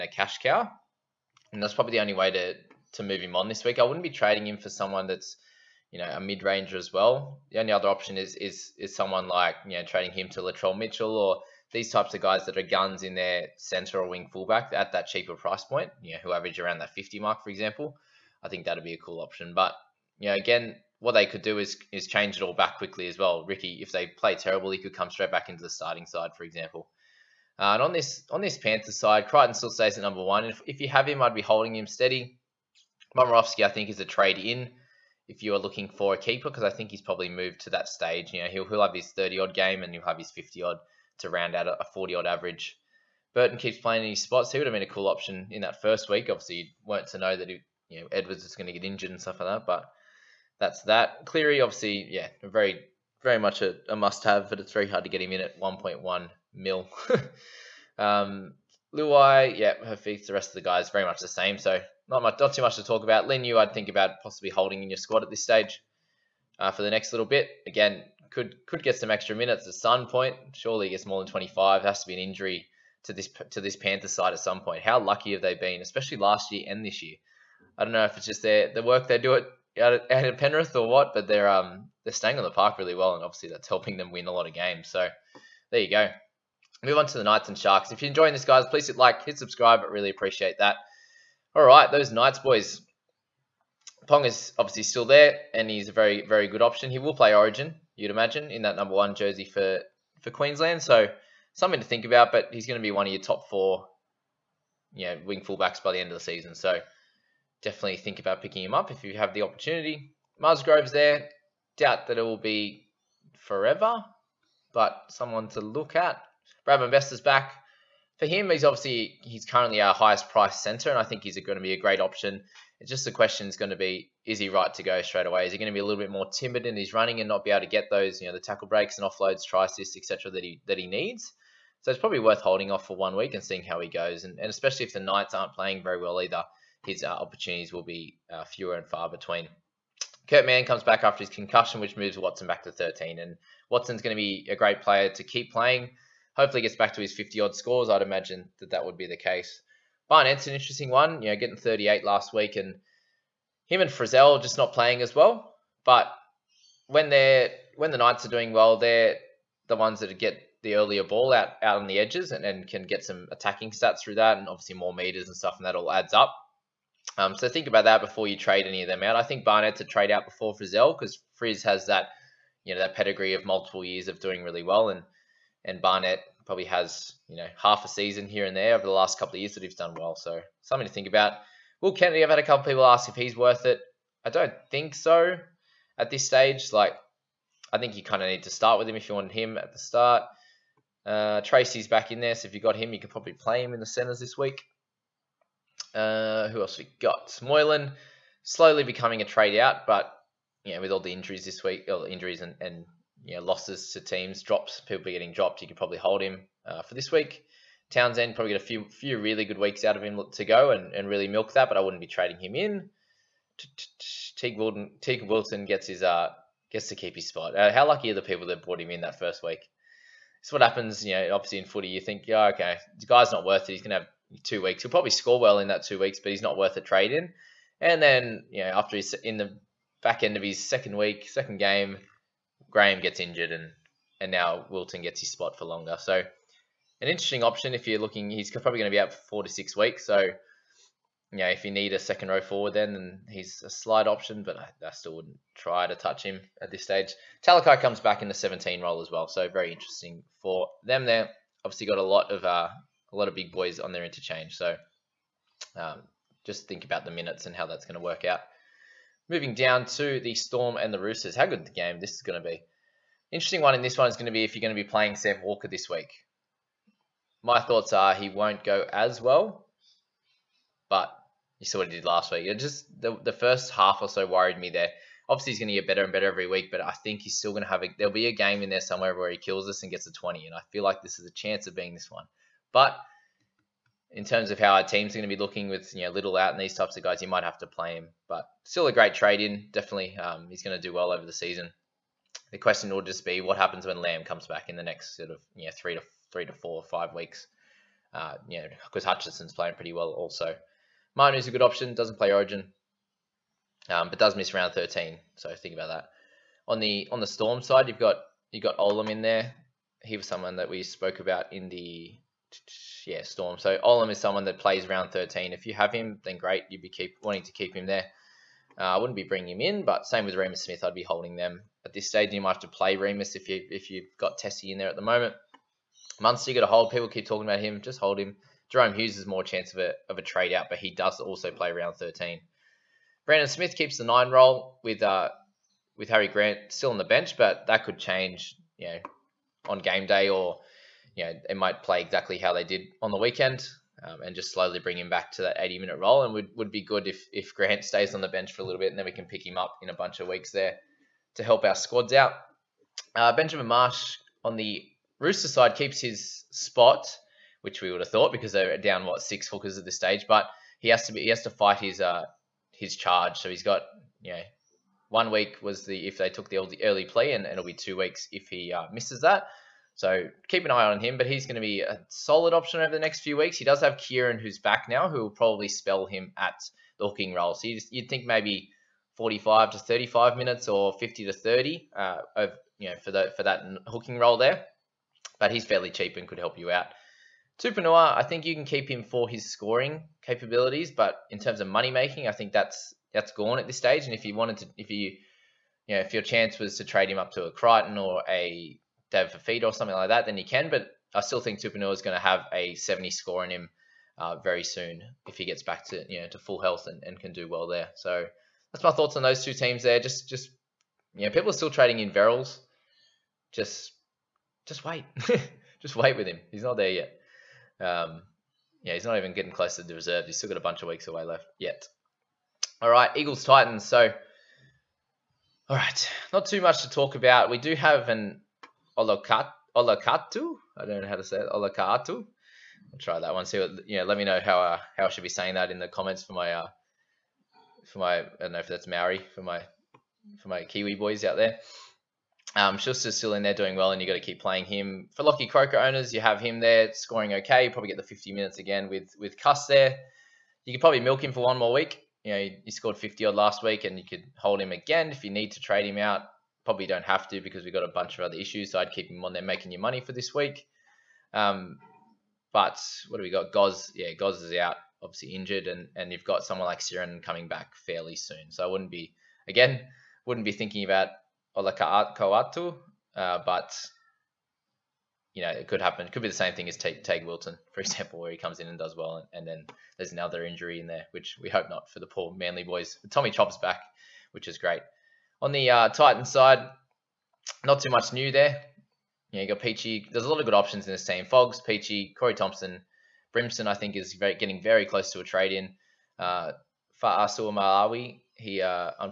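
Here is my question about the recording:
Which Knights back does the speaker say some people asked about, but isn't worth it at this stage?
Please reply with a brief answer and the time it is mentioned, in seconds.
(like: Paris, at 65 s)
Will Kennedy, at 181 s.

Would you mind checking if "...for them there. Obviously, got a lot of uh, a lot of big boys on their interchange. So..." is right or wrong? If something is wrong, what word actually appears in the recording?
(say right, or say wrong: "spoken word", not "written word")
right.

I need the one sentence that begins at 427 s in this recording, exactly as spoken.
We do have an Olokat, Olokatu.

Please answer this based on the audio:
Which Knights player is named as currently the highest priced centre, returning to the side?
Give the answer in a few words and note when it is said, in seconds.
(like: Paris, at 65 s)
Brad Best, at 116 s.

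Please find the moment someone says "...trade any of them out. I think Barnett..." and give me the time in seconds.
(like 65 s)
168 s.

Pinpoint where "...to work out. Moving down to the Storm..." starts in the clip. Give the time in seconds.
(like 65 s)
257 s.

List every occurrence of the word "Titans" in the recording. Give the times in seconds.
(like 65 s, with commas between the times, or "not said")
423 s, 485 s.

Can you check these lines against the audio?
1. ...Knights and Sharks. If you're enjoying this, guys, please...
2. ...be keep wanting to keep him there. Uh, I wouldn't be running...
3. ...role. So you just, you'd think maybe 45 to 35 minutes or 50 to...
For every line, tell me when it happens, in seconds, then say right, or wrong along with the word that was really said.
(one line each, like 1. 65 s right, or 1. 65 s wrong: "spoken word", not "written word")
1. 87 s right
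2. 316 s wrong: "bringing", not "running"
3. 377 s right.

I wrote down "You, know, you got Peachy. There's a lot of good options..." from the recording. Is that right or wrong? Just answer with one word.
right.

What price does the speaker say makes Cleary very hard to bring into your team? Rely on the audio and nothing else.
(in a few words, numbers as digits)
1.1 mil.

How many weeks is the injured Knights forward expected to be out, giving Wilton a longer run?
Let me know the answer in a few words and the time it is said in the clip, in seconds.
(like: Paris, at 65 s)
4 to 6 weeks, at 239 s.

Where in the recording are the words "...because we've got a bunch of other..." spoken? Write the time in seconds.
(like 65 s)
457 s.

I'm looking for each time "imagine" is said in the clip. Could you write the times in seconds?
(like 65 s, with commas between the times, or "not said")
98 s, 148 s.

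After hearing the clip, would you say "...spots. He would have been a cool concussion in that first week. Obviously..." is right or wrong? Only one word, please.
wrong.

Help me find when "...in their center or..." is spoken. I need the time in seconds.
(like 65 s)
13 s.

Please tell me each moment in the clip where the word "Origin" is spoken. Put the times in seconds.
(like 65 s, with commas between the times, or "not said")
97 s, 302 s.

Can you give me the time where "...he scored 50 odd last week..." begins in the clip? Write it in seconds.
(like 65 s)
452 s.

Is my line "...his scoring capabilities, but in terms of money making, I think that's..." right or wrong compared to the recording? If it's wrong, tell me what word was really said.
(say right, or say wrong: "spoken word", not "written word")
right.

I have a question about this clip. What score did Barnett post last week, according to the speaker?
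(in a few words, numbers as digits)
38.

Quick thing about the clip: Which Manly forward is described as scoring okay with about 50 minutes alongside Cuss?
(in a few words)
Lockie Croker.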